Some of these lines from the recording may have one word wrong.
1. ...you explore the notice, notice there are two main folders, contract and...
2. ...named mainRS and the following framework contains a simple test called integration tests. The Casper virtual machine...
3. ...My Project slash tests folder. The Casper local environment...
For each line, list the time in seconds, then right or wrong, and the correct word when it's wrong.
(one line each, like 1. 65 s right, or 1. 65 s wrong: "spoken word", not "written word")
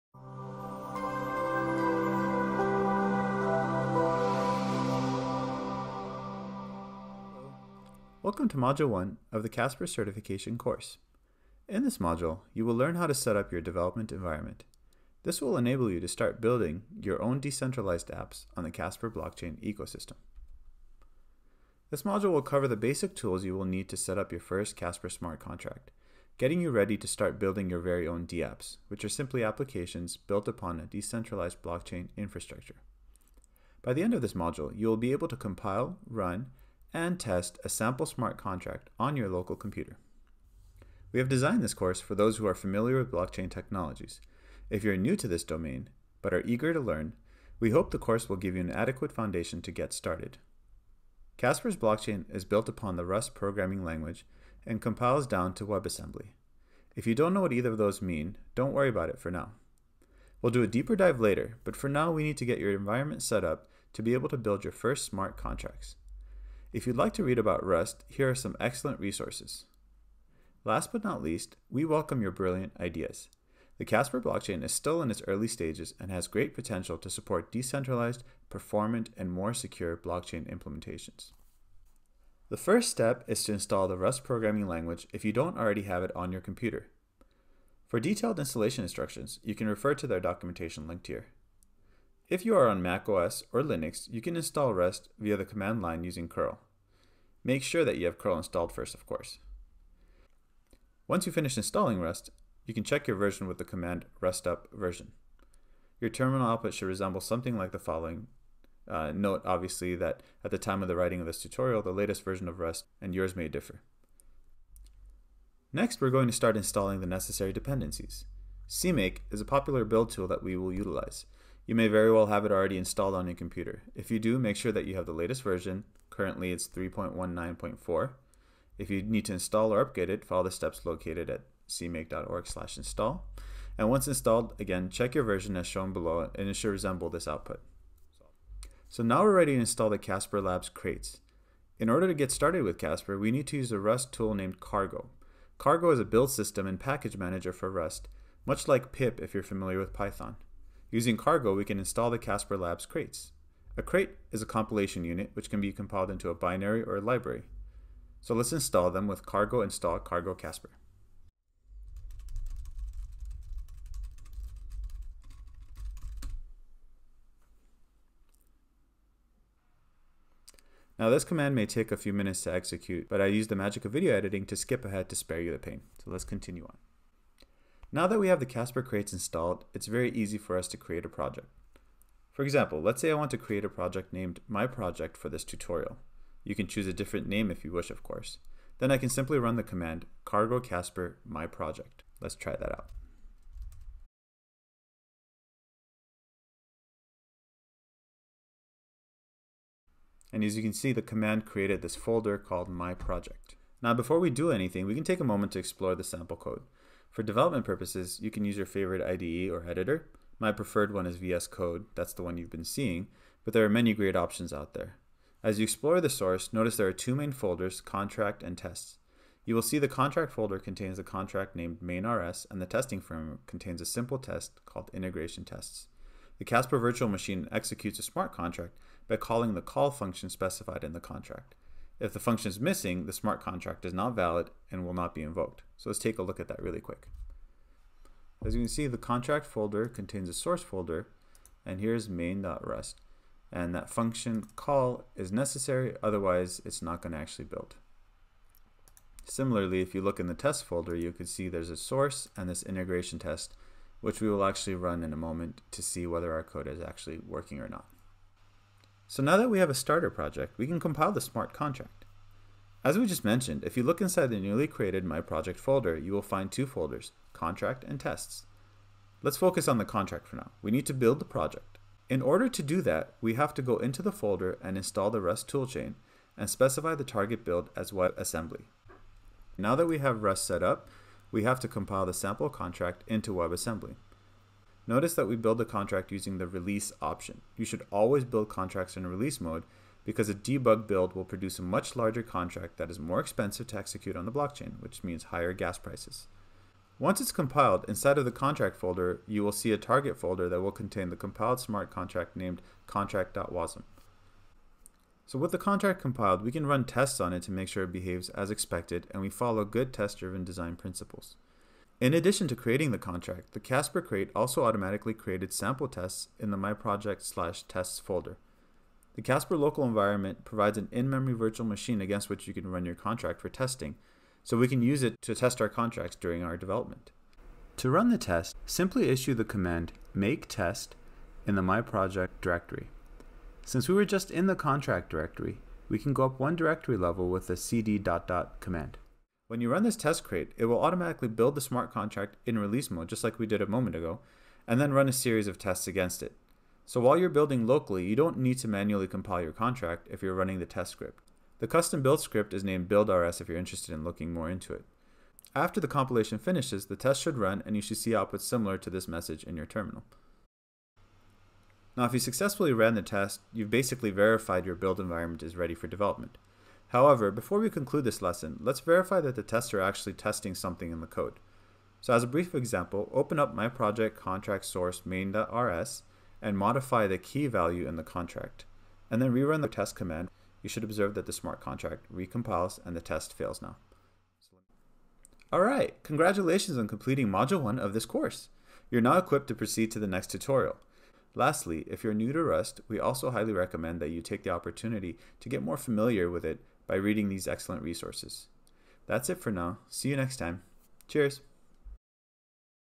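1. 215 s wrong: "source", not "notice"
2. 221 s wrong: "testing", not "following"
3. 316 s right.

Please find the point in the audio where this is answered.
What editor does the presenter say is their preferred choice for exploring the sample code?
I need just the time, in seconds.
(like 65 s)
211 s.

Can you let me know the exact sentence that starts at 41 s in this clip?
We have designed this course for those who are familiar with blockchain technologies.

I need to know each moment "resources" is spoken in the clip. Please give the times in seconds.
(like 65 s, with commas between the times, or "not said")
68 s, 397 s.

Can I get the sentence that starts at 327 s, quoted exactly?
To run the test, simply issue the command make test in the My Project directory.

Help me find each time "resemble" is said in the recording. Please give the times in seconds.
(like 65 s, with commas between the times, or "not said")
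106 s, 136 s.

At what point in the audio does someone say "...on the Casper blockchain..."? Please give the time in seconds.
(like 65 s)
18 s.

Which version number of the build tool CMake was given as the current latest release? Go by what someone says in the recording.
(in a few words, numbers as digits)
3.19.4.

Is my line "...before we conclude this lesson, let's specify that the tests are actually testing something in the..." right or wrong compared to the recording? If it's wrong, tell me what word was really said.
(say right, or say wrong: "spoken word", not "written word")
wrong: "verify", not "specify".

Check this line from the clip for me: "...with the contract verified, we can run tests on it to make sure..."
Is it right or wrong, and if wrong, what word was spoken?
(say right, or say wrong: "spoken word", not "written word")
wrong: "compiled", not "verified".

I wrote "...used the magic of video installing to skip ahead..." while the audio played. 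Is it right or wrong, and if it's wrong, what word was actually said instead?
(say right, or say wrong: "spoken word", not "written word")
wrong: "editing", not "installing".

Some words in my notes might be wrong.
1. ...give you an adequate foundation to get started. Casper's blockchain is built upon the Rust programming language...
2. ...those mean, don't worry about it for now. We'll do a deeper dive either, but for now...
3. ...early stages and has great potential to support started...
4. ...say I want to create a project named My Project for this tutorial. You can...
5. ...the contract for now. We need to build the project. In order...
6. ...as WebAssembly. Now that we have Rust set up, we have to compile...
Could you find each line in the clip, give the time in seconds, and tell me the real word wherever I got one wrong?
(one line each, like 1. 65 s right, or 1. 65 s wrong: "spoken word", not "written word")
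1. 48 s right
2. 57 s wrong: "later", not "either"
3. 75 s wrong: "decentralized", not "started"
4. 183 s right
5. 269 s right
6. 277 s right.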